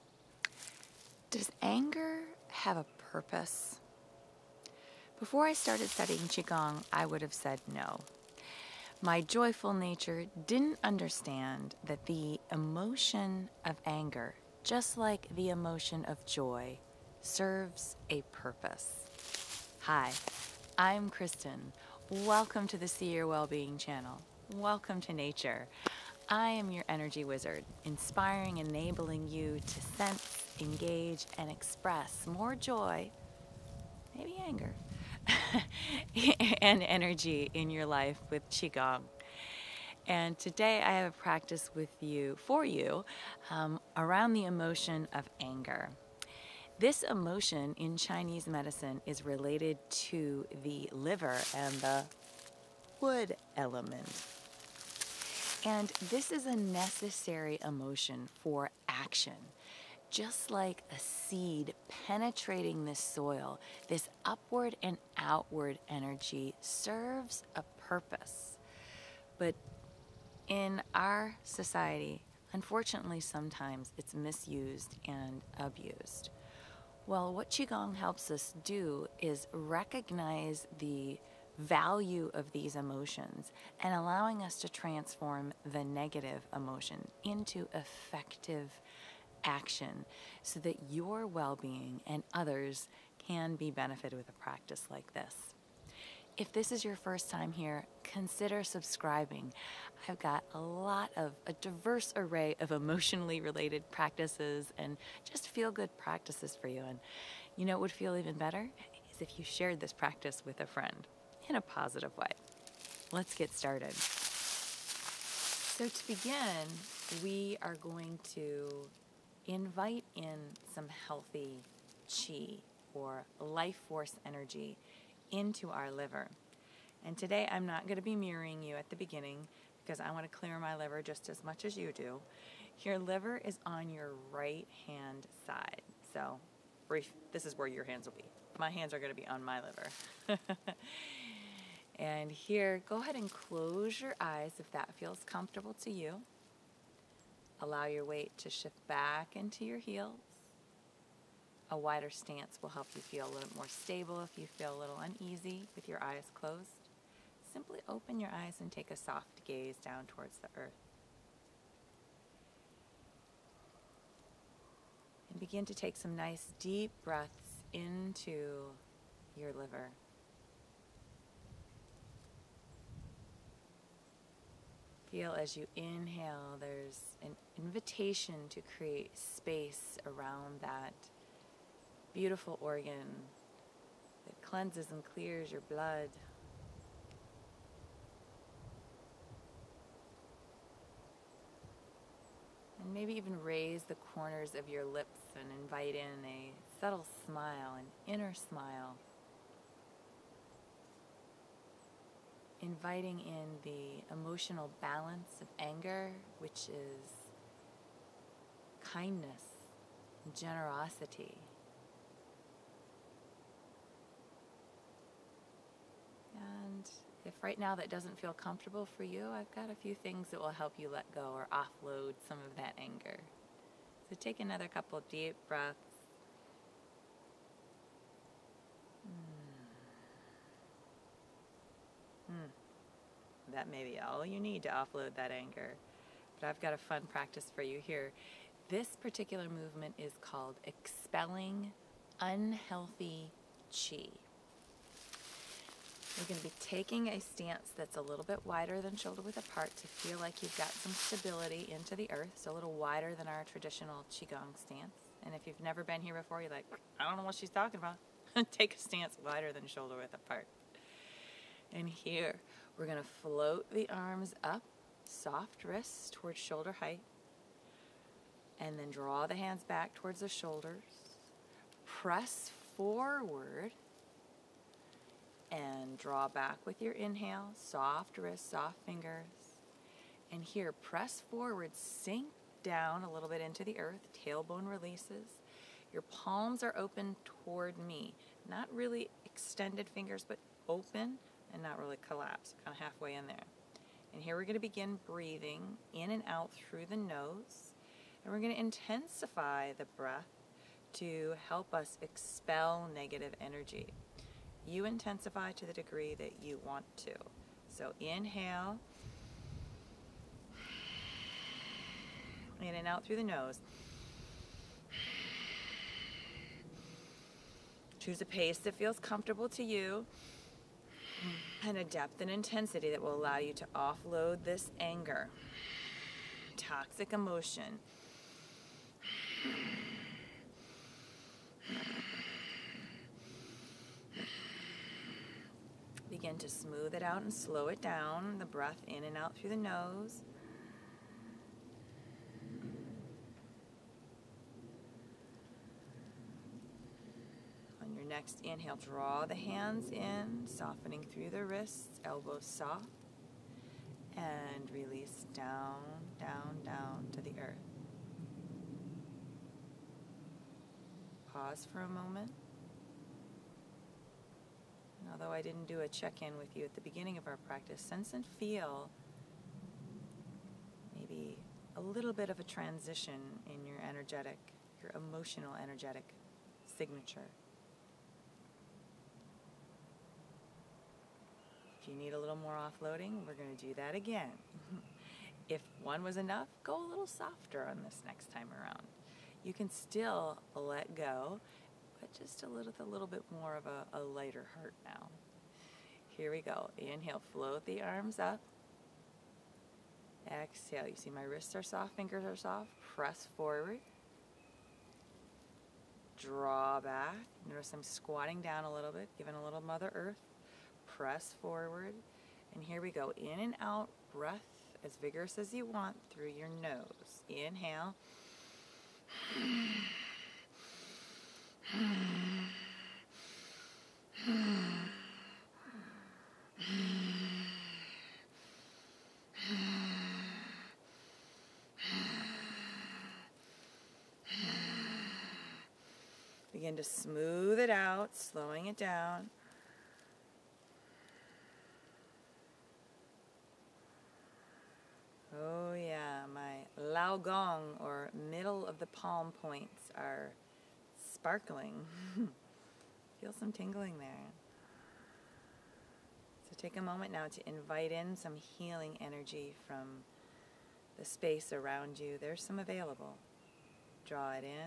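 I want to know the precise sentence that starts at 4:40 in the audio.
And here, press forward, sink down a little bit into the earth, tailbone releases.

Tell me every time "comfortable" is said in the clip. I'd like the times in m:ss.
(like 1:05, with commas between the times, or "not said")
2:25, 3:38, 5:18.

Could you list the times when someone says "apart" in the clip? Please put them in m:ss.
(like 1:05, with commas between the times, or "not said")
4:09, 4:20.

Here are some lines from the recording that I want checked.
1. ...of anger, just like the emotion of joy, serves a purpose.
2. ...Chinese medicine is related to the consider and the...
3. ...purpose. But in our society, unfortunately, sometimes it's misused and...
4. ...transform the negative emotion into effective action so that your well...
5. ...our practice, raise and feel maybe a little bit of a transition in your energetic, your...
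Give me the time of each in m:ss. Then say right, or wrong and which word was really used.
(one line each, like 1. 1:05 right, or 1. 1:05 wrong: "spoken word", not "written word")
1. 0:13 right
2. 0:47 wrong: "liver", not "consider"
3. 1:07 right
4. 1:24 right
5. 6:07 wrong: "sense", not "raise".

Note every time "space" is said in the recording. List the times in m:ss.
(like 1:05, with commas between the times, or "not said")
2:59, 7:41.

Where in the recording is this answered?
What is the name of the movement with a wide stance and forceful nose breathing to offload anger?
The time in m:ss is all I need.
4:00.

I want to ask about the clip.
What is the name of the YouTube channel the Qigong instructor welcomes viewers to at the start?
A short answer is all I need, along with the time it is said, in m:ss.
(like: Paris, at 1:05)
See Your Wellbeing, at 0:22.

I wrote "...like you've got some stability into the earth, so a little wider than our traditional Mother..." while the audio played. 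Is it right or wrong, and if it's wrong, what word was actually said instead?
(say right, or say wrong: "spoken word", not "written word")
wrong: "Qigong", not "Mother".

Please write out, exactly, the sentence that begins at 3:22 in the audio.
inviting in the emotional balance of anger, which is kindness, generosity.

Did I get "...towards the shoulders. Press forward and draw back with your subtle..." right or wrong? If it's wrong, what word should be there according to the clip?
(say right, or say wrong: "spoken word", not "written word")
wrong: "inhale", not "subtle".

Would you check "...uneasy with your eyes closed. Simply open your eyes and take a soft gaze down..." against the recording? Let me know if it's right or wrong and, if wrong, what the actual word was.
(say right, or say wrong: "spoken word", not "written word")
right.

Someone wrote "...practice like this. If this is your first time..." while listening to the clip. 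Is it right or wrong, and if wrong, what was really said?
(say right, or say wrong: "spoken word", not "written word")
right.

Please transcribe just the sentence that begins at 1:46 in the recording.
And you know it would feel even better?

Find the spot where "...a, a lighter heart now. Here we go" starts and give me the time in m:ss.
6:33.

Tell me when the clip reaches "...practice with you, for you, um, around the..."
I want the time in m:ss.
0:41.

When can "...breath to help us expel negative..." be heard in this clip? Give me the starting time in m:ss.
4:59.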